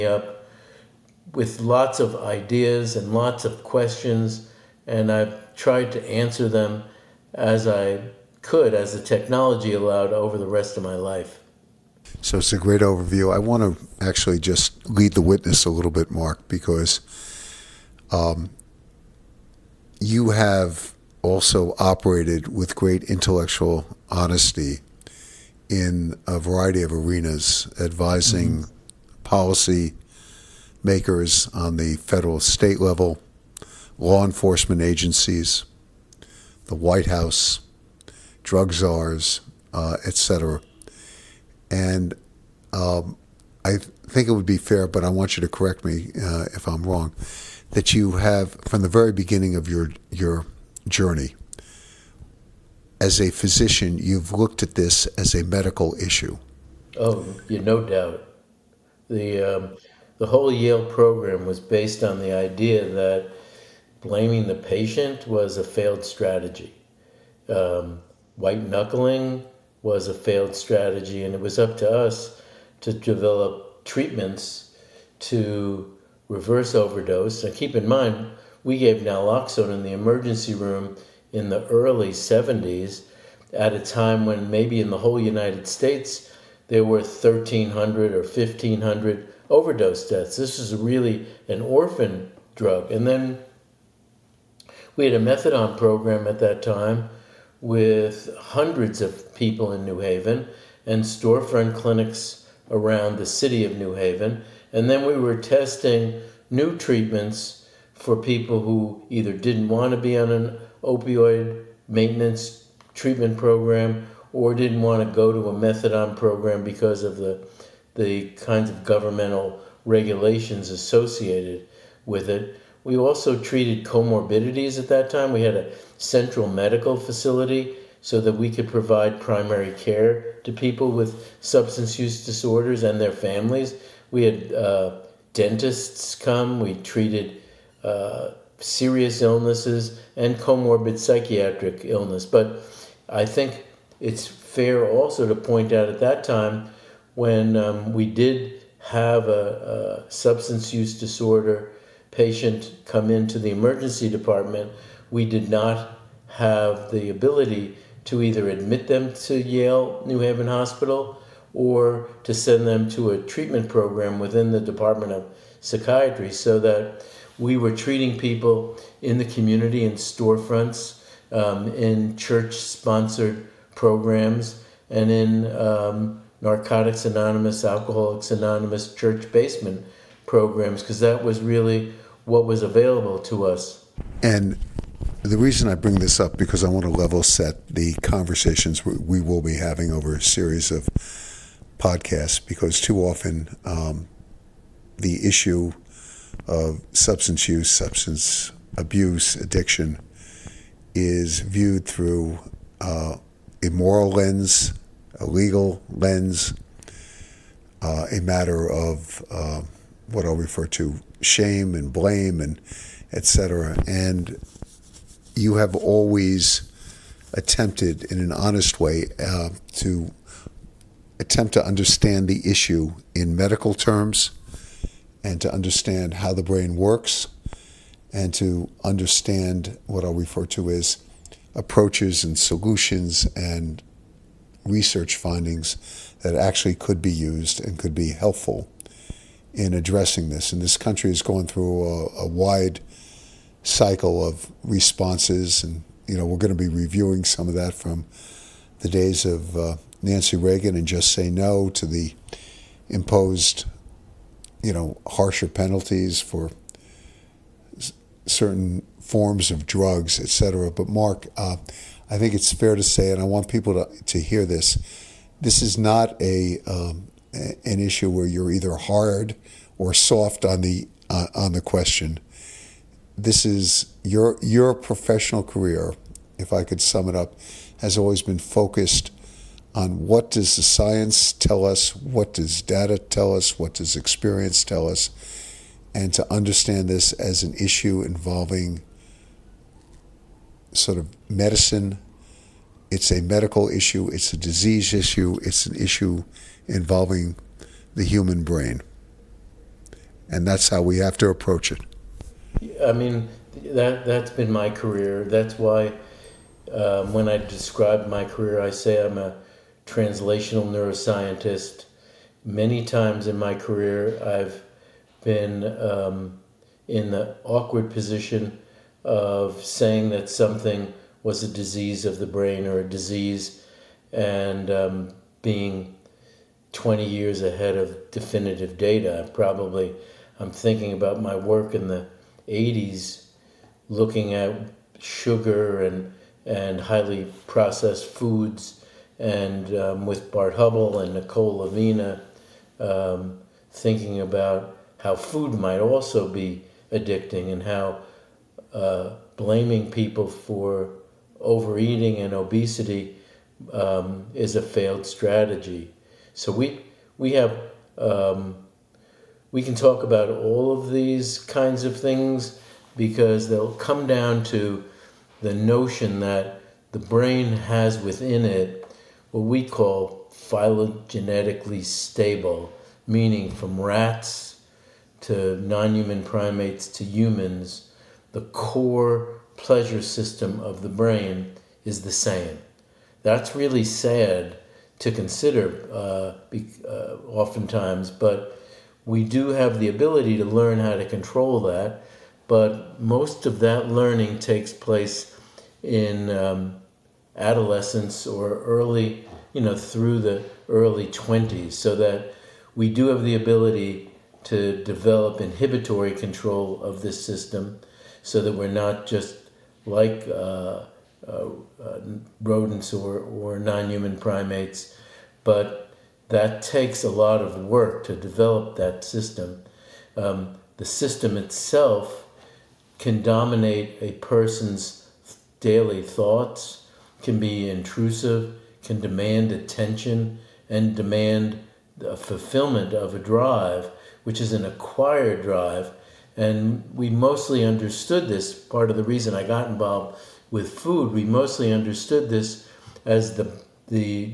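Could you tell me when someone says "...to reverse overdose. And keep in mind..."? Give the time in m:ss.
1:15.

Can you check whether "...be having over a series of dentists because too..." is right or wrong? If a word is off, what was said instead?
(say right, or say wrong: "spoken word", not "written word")
wrong: "podcasts", not "dentists".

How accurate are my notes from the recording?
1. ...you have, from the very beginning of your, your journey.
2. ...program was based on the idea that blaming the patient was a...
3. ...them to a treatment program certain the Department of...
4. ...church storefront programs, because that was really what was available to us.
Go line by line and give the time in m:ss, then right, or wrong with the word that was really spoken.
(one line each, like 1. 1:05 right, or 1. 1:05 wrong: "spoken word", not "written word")
1. 0:47 right
2. 1:00 right
3. 2:42 wrong: "within", not "certain"
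4. 2:58 wrong: "basement", not "storefront".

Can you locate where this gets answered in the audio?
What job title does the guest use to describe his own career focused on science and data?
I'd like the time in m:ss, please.
5:09.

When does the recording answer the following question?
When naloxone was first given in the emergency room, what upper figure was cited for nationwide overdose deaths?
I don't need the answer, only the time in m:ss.
1:28.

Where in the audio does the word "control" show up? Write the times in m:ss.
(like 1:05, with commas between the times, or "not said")
6:31, 6:46.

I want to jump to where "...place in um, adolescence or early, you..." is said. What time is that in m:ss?
6:34.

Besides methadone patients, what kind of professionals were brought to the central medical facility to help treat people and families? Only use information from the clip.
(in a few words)
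Dentists.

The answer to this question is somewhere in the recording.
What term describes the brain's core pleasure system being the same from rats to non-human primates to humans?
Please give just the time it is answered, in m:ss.
6:10.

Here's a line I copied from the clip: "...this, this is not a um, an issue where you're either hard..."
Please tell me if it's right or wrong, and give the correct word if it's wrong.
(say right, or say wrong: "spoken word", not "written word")
right.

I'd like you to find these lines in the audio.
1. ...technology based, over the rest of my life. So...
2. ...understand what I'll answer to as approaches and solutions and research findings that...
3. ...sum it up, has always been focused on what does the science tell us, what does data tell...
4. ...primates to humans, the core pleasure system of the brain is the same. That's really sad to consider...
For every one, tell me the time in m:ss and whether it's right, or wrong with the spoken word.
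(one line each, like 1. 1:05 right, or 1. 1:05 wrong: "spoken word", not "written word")
1. 0:09 wrong: "allowed", not "based"
2. 3:48 wrong: "refer", not "answer"
3. 4:36 right
4. 6:16 right.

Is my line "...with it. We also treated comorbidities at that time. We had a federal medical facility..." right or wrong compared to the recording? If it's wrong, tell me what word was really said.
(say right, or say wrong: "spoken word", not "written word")
wrong: "central", not "federal".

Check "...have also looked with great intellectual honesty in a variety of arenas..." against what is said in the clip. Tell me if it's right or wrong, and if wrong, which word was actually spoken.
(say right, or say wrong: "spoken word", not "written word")
wrong: "operated", not "looked".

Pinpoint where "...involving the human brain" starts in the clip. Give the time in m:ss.
4:56.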